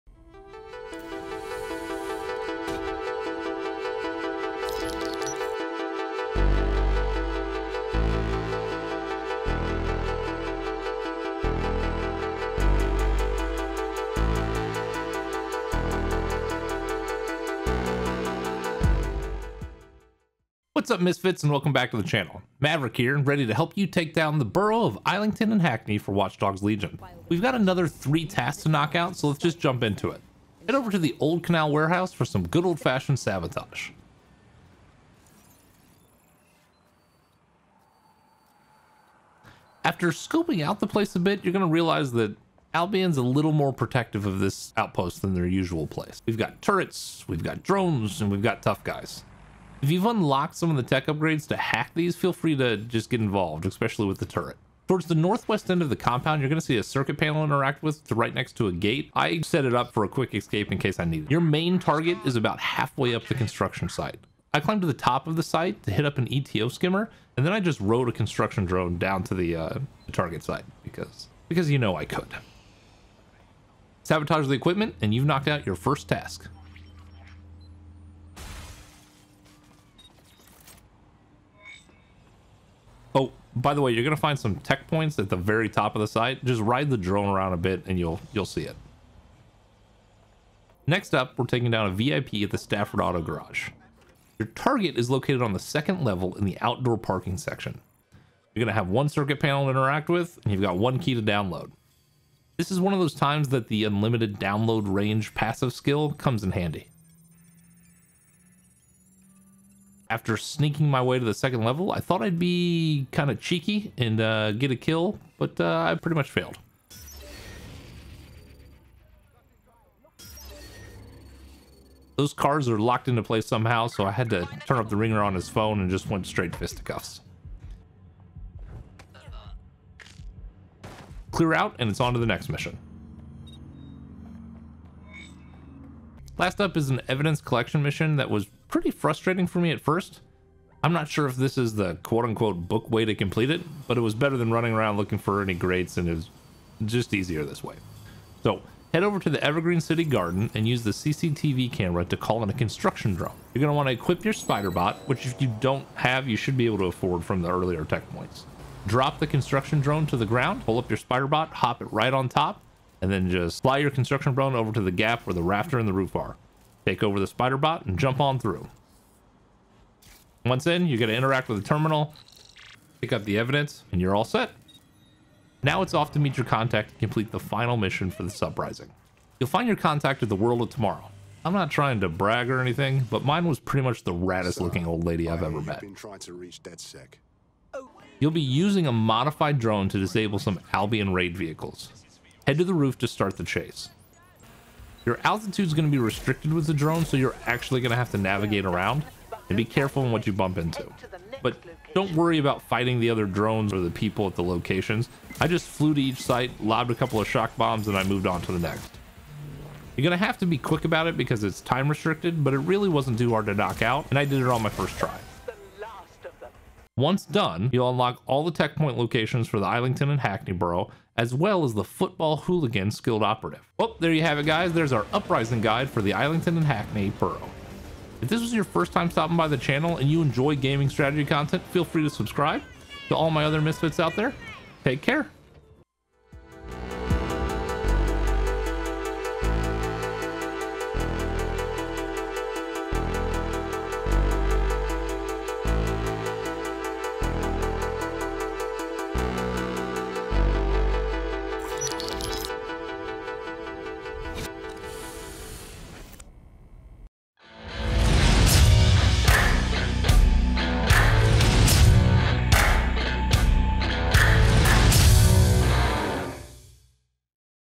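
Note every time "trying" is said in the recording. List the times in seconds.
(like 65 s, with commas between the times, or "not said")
181 s, 185 s.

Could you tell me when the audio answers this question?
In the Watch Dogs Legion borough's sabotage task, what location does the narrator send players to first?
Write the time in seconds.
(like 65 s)
31 s.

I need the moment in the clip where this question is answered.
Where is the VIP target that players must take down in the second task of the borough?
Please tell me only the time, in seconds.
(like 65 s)
92 s.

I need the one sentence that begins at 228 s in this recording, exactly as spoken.
If this was your first time stopping by the channel and you enjoy gaming strategy content, feel free to subscribe.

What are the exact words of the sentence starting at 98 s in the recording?
You're gonna have one circuit panel to interact with, and you've got one key to download.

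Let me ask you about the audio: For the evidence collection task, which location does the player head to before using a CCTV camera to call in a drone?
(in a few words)
Evergreen City Garden.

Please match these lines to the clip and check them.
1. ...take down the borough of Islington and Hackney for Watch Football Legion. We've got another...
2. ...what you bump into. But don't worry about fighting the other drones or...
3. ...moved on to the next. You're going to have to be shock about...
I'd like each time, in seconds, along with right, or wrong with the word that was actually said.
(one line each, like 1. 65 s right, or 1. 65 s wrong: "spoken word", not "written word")
1. 23 s wrong: "Dogs", not "Football"
2. 200 s right
3. 208 s wrong: "quick", not "shock".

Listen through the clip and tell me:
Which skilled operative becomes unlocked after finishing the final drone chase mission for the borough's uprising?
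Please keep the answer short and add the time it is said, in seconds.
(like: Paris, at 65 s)
Football Hooligan, at 221 s.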